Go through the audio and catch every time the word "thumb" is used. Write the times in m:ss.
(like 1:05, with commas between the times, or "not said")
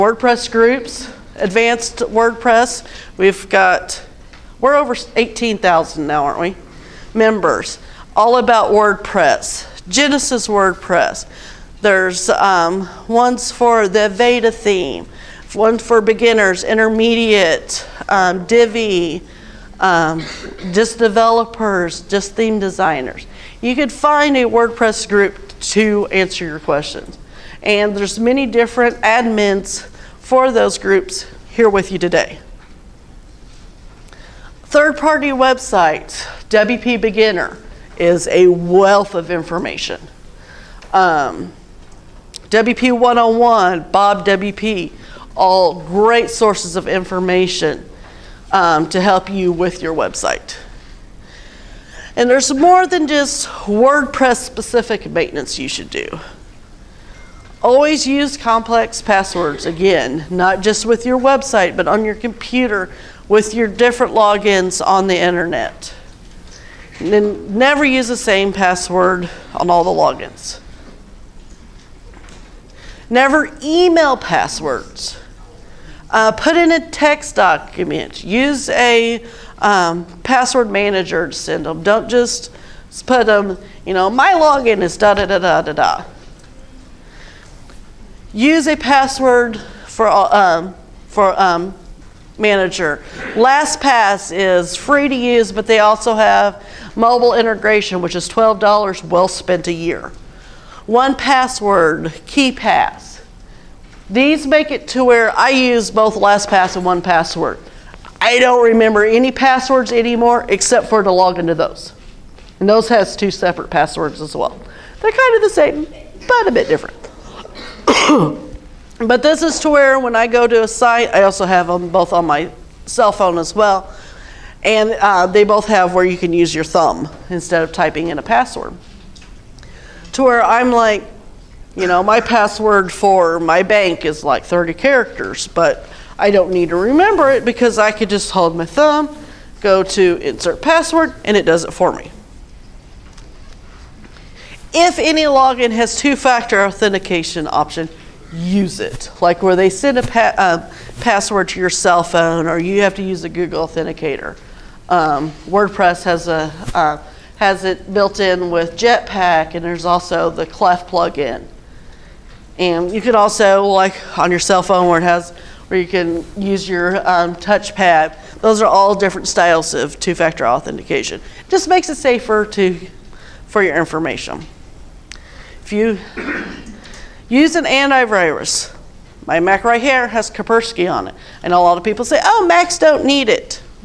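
2:06, 2:18.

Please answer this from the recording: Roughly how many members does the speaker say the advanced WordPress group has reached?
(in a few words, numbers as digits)
18,000.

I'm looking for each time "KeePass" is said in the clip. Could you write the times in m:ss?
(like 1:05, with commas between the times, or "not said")
1:42.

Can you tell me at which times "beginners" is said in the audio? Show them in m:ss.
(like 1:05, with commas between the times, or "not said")
0:16, 0:37.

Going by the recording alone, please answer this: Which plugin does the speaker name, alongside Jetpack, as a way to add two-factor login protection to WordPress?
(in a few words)
Clef.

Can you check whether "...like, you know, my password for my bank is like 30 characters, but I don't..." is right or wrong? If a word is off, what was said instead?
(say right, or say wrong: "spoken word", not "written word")
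right.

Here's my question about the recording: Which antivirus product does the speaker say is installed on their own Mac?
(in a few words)
Kaspersky.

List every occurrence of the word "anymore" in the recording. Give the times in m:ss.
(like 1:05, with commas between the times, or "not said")
1:49.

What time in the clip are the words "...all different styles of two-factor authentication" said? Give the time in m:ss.
2:48.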